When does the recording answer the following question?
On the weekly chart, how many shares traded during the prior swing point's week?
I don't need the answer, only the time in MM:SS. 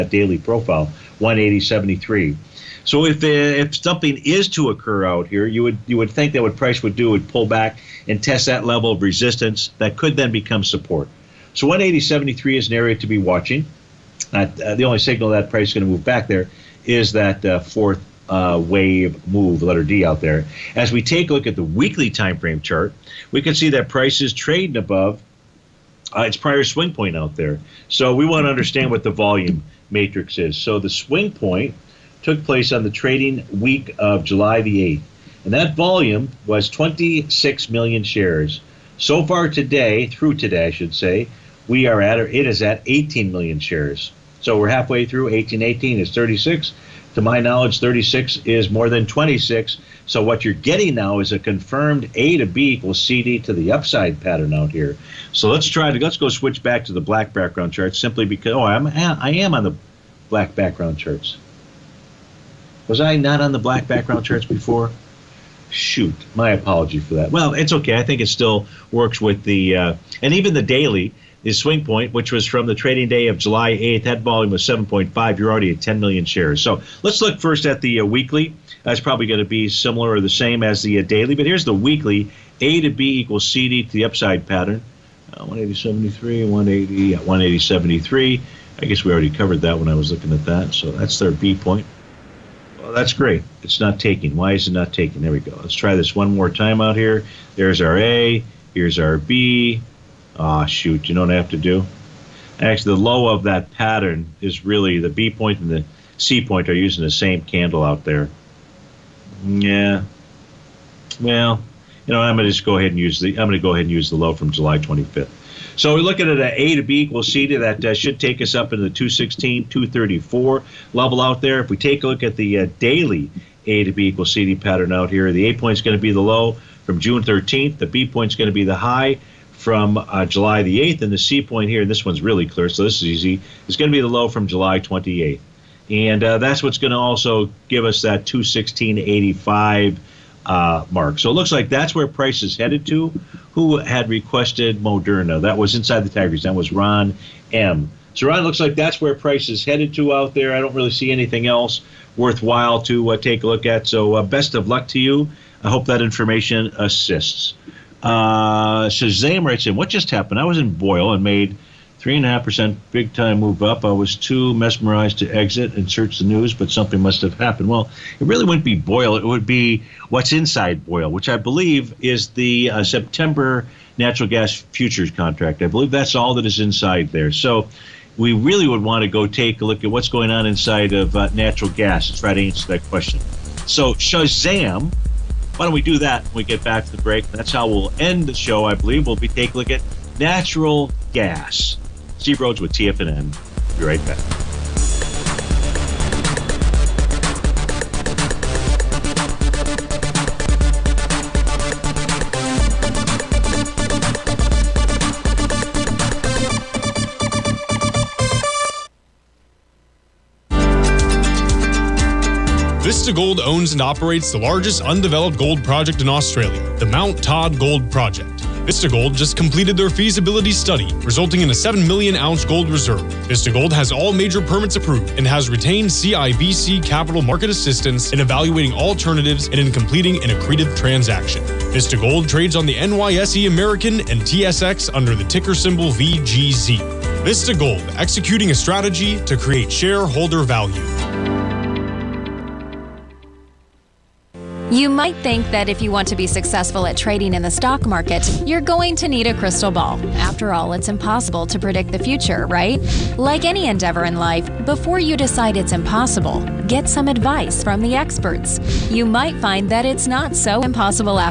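00:36.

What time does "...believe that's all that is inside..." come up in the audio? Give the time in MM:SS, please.
02:55.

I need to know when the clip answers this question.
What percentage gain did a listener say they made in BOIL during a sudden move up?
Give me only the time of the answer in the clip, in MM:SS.
02:41.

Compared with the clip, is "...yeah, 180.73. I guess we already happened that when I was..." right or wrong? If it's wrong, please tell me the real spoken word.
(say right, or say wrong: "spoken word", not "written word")
wrong: "covered", not "happened".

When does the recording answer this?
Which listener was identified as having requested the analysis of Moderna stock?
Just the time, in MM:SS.
02:26.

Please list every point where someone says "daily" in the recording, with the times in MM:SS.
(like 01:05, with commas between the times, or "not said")
00:00, 01:10, 01:21, 02:02.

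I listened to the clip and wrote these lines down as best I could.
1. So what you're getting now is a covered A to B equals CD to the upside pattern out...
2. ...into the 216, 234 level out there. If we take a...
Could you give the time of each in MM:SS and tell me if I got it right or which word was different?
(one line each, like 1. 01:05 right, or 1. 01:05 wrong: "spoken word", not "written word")
1. 00:50 wrong: "confirmed", not "covered"
2. 01:58 right.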